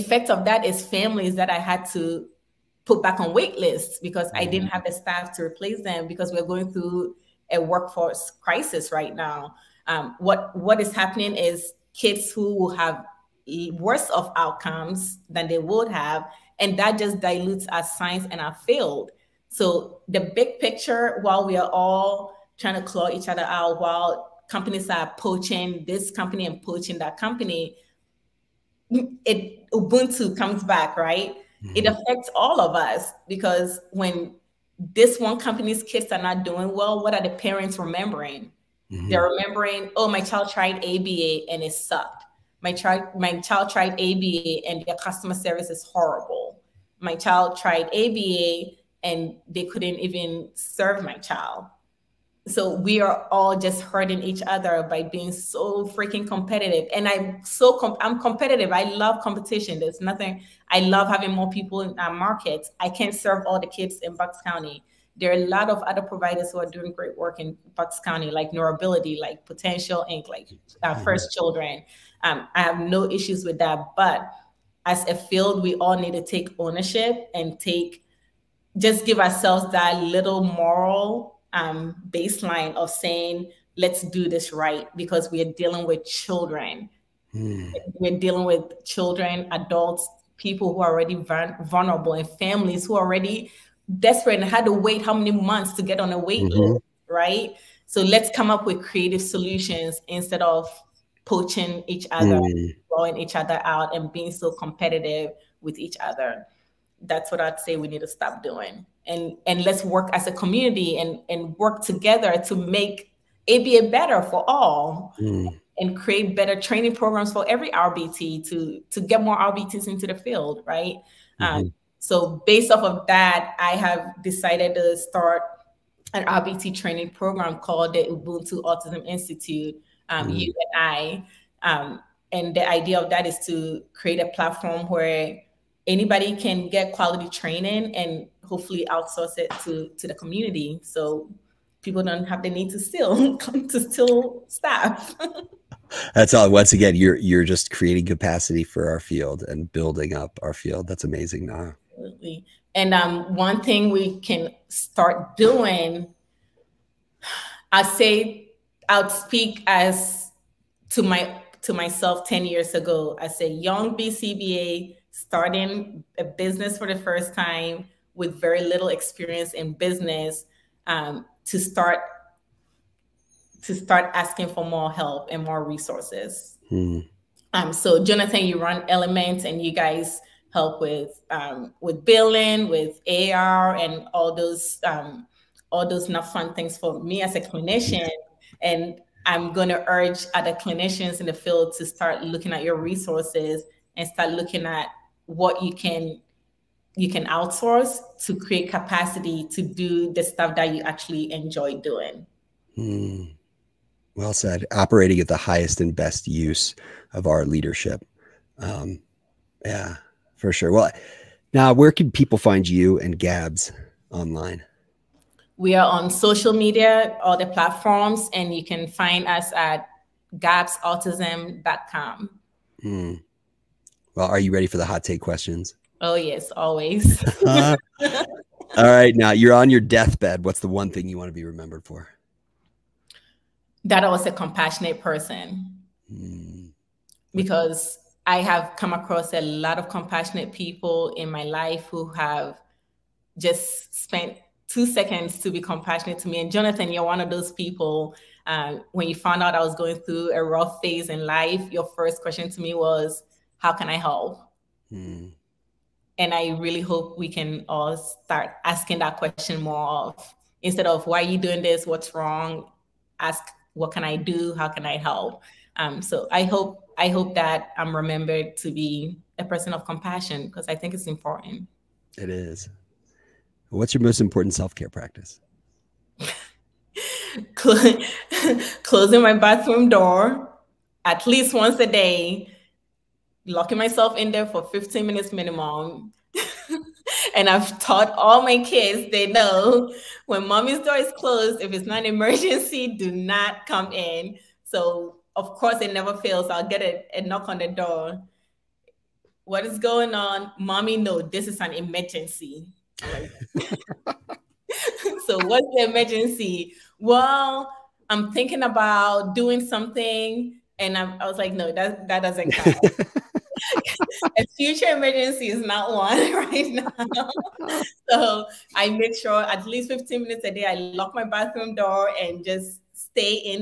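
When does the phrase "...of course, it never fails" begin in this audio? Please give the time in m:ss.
4:55.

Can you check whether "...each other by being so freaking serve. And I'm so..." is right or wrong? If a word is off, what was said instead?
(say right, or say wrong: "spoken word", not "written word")
wrong: "competitive", not "serve".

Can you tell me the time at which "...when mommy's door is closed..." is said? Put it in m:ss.
4:50.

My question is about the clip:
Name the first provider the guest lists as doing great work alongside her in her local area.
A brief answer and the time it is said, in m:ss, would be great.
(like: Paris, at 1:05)
NeuroAbility, at 1:08.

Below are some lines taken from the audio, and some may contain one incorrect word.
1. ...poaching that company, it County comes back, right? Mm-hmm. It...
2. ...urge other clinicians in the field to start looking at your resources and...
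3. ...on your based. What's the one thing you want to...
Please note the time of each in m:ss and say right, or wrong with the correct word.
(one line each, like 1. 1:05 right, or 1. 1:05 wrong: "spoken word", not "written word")
1. 0:26 wrong: "Ubuntu", not "County"
2. 3:09 right
3. 3:49 wrong: "deathbed", not "based".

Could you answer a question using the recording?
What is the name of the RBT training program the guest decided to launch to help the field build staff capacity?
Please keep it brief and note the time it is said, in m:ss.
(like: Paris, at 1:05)
Ubuntu Autism Institute, at 2:08.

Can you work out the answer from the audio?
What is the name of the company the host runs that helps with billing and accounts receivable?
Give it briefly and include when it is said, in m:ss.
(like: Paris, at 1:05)
Element, at 2:58.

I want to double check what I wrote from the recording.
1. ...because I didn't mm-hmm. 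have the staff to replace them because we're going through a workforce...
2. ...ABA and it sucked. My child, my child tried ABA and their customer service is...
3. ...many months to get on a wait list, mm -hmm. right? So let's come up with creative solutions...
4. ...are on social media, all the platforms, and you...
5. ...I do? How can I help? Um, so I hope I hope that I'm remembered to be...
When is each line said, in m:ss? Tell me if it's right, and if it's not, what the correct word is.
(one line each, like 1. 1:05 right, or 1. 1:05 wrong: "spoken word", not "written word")
1. 0:04 right
2. 0:40 right
3. 1:35 right
4. 3:35 right
5. 4:24 right.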